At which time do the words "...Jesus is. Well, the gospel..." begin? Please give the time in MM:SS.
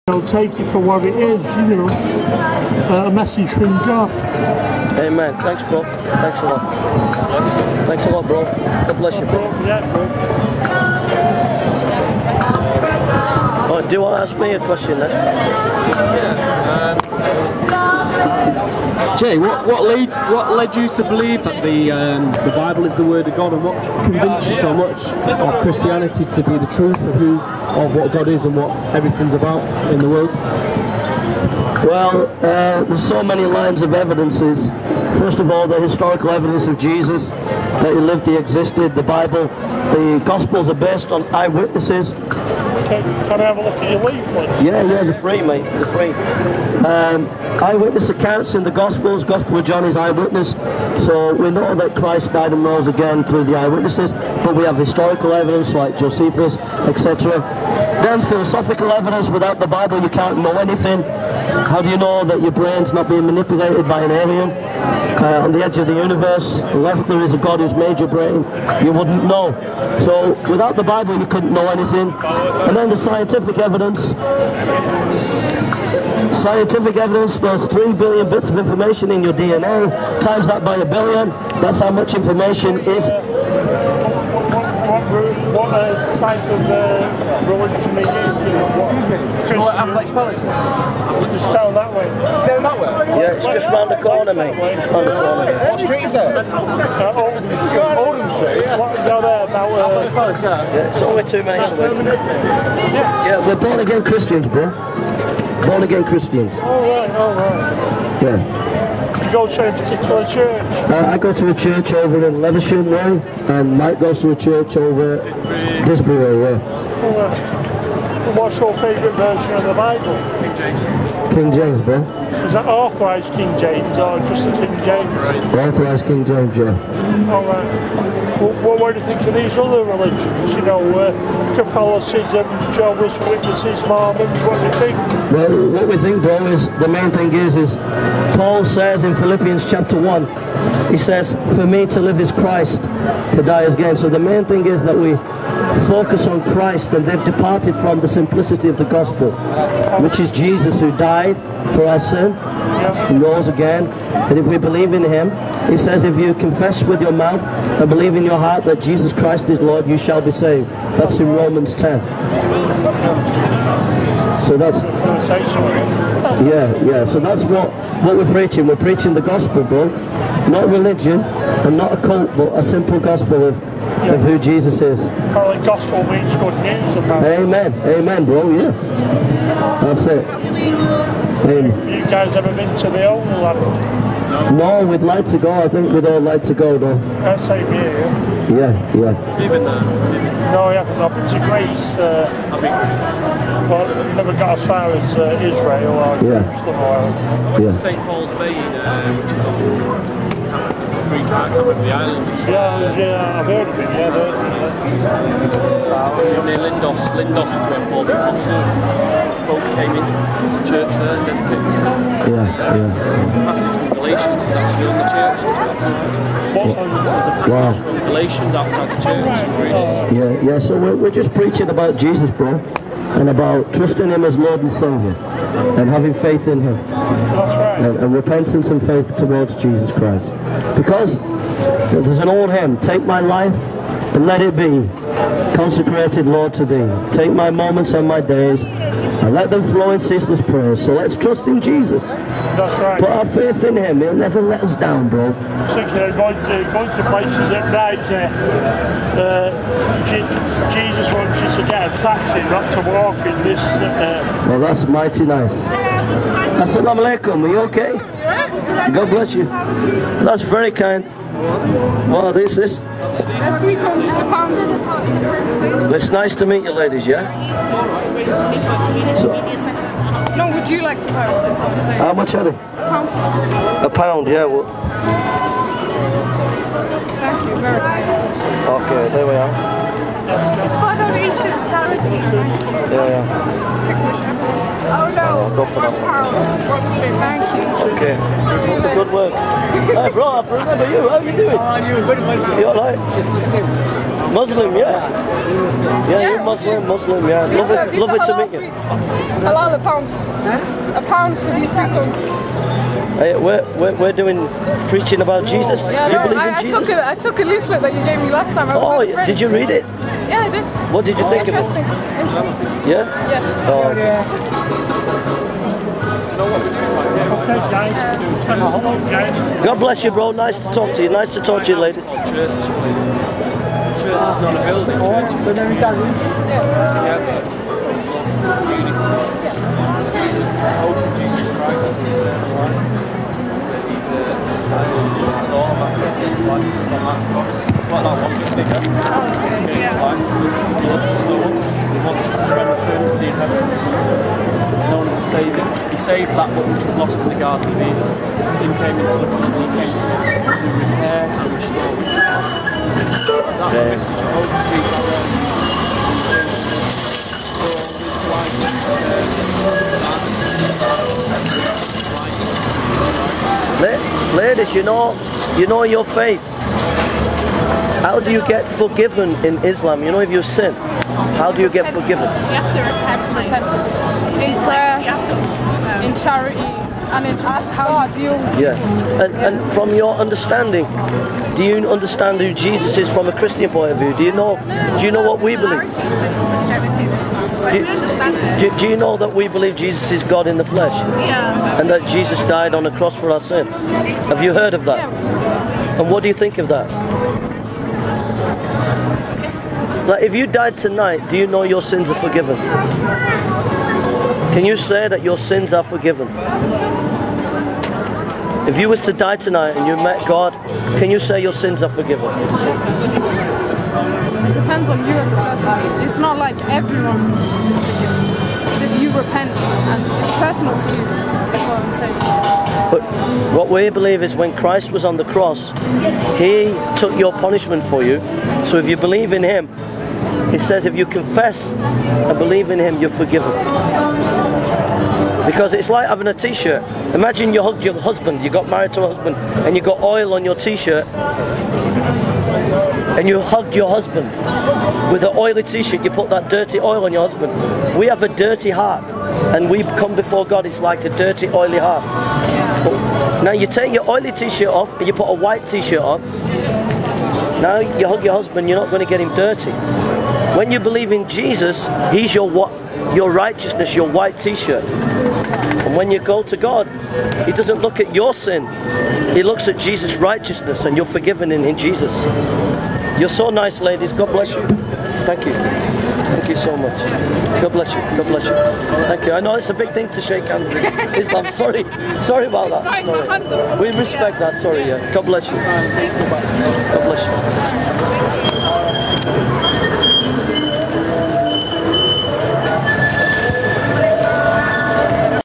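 02:54.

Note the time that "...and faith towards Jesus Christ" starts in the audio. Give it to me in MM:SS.
03:48.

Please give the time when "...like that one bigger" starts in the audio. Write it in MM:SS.
05:37.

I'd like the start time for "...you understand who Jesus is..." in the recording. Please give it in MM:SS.
06:21.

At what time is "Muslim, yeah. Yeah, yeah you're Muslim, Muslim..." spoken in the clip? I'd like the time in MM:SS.
04:54.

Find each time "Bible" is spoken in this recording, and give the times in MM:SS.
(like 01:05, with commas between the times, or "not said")
00:22, 00:39, 00:59, 01:10, 01:59.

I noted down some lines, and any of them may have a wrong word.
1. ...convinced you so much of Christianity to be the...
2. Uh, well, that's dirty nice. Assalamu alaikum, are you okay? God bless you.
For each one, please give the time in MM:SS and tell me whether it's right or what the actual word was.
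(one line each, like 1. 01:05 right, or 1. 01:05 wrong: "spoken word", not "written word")
1. 00:24 right
2. 04:13 wrong: "mighty", not "dirty".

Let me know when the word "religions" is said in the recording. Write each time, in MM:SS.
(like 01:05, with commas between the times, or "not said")
02:09, 02:50.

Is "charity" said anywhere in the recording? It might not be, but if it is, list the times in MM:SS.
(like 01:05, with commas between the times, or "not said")
04:41, 06:16.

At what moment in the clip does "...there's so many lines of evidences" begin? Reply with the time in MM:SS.
00:32.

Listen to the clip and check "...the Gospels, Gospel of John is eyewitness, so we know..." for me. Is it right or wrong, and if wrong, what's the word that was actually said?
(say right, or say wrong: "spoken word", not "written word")
right.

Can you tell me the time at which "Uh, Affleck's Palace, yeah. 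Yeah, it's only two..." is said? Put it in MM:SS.
01:39.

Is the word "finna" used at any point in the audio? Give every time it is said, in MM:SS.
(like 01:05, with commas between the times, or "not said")
not said.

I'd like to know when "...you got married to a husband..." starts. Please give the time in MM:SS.
07:18.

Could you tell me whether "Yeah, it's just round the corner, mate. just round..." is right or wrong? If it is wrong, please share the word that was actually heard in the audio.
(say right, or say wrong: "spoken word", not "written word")
right.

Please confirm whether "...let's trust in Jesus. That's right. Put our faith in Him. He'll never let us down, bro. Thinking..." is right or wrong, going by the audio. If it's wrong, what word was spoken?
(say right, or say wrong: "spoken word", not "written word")
right.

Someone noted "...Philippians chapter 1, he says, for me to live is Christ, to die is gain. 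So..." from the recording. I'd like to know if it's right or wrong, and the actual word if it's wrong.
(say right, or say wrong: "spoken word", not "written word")
right.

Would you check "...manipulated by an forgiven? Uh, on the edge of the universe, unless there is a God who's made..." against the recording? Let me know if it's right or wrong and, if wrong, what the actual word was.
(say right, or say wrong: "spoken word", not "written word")
wrong: "alien", not "forgiven".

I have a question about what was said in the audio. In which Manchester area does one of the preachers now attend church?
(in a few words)
Levenshulme.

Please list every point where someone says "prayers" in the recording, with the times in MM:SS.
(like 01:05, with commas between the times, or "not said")
04:00, 06:14.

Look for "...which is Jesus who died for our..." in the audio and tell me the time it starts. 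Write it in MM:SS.
02:30.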